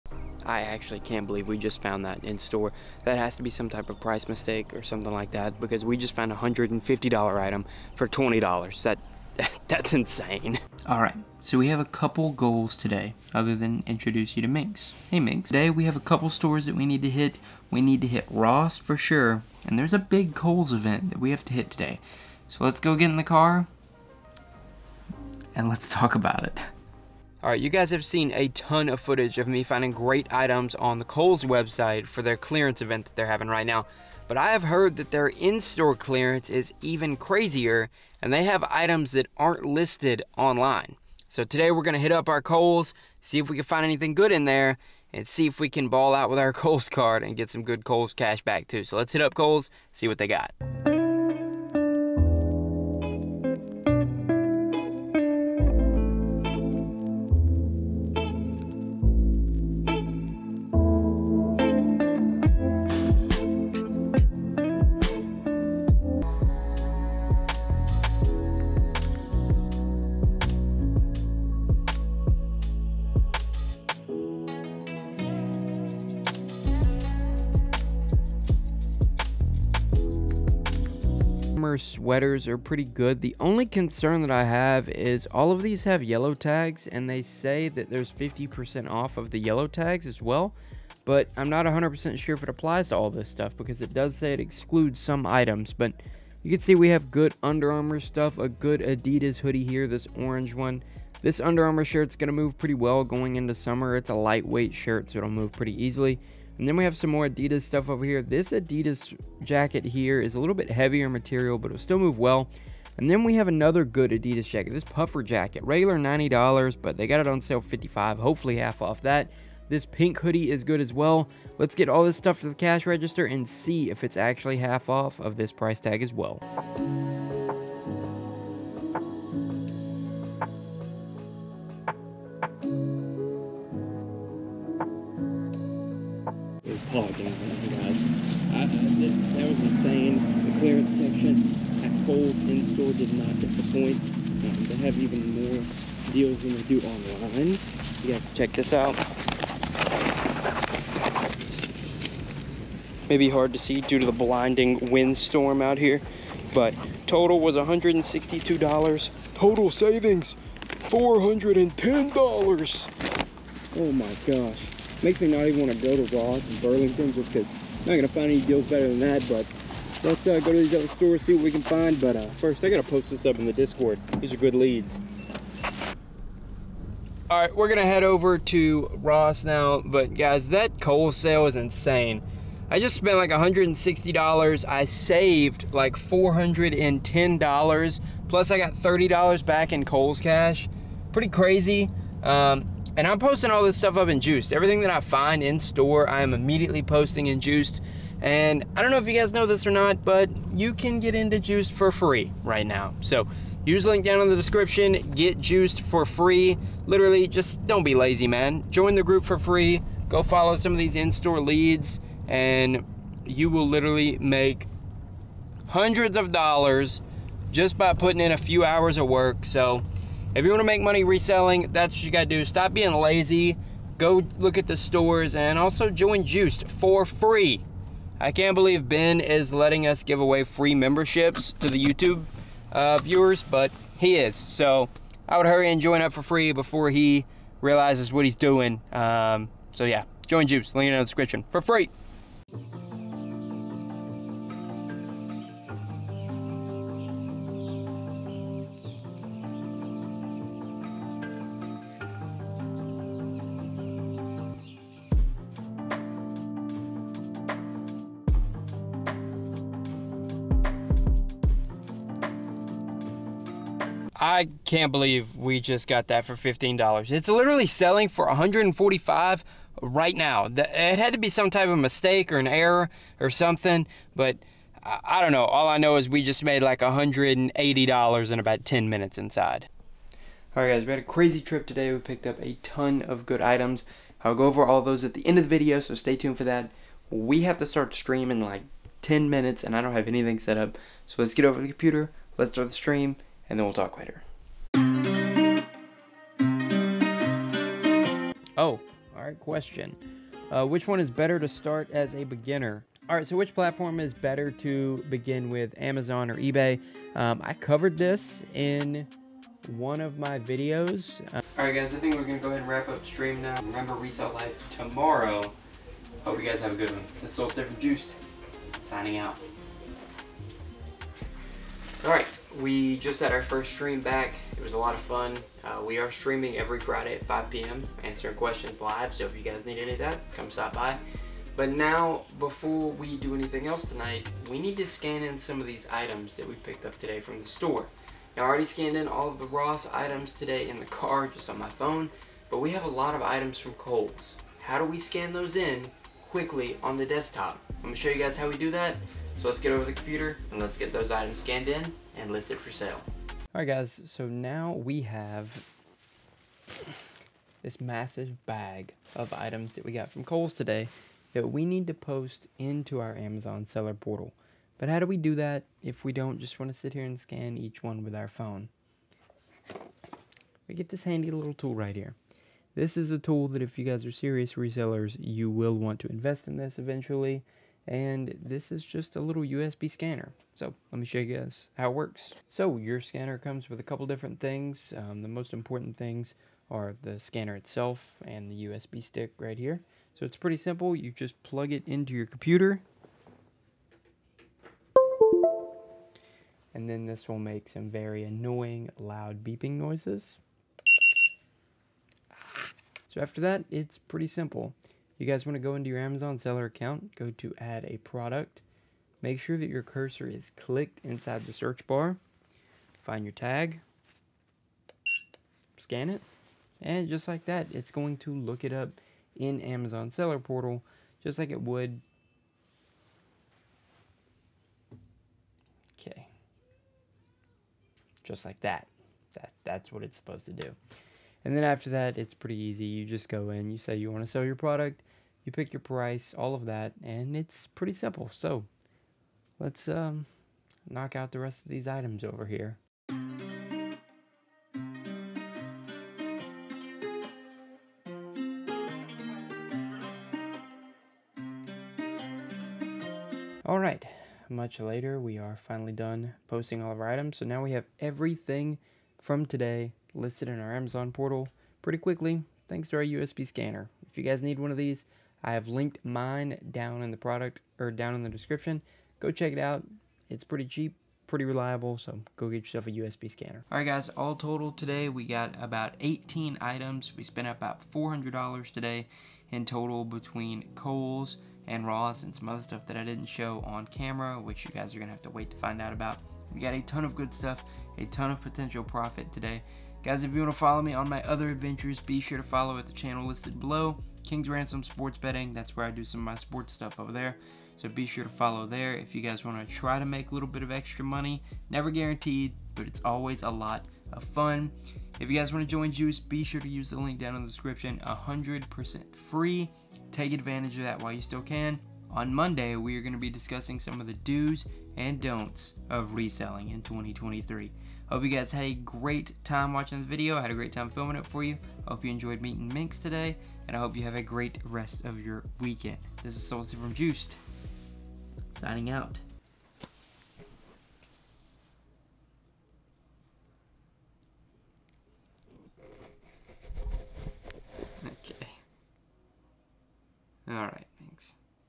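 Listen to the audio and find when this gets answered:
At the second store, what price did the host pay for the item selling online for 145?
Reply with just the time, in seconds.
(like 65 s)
266 s.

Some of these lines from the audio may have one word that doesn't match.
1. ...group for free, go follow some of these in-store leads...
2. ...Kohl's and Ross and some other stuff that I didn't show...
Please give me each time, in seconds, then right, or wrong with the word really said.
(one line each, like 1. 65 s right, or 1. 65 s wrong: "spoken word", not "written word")
1. 209 s right
2. 480 s right.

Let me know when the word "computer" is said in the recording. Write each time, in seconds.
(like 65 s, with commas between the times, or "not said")
291 s, 349 s, 392 s.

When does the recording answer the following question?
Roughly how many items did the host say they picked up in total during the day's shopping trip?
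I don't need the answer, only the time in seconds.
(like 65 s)
475 s.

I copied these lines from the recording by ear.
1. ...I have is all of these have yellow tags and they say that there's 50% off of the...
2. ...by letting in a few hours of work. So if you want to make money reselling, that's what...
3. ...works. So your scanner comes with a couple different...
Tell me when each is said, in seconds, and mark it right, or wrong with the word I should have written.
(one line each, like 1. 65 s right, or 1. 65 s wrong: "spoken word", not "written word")
1. 84 s right
2. 217 s wrong: "putting", not "letting"
3. 381 s right.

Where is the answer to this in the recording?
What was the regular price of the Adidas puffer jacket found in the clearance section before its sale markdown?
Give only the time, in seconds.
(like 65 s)
115 s.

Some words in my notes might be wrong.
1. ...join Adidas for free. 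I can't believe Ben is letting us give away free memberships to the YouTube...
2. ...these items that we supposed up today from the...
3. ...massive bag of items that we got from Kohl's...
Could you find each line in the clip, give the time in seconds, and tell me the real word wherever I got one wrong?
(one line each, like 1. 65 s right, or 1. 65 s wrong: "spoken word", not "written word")
1. 225 s wrong: "Juiced", not "Adidas"
2. 335 s wrong: "picked", not "supposed"
3. 357 s right.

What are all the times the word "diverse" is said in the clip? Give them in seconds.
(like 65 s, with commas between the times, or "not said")
not said.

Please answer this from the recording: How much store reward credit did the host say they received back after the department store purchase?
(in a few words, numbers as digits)
$30.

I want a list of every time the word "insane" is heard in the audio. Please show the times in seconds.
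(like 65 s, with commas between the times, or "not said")
9 s, 139 s, 181 s.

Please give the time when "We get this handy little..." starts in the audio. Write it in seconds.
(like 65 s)
370 s.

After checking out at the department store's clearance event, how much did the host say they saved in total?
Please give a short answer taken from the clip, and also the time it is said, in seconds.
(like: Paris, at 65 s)
$410, at 159 s.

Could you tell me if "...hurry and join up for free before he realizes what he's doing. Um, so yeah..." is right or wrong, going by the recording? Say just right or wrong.
right.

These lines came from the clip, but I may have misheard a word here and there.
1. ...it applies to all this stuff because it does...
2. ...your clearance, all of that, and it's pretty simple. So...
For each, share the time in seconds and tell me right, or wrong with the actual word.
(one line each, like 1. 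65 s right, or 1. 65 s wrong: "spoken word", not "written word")
1. 92 s right
2. 435 s wrong: "price", not "clearance".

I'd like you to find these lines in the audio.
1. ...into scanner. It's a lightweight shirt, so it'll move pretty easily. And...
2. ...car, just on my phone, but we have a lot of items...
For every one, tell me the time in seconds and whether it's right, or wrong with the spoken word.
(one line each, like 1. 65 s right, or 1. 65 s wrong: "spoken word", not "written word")
1. 103 s wrong: "summer", not "scanner"
2. 340 s right.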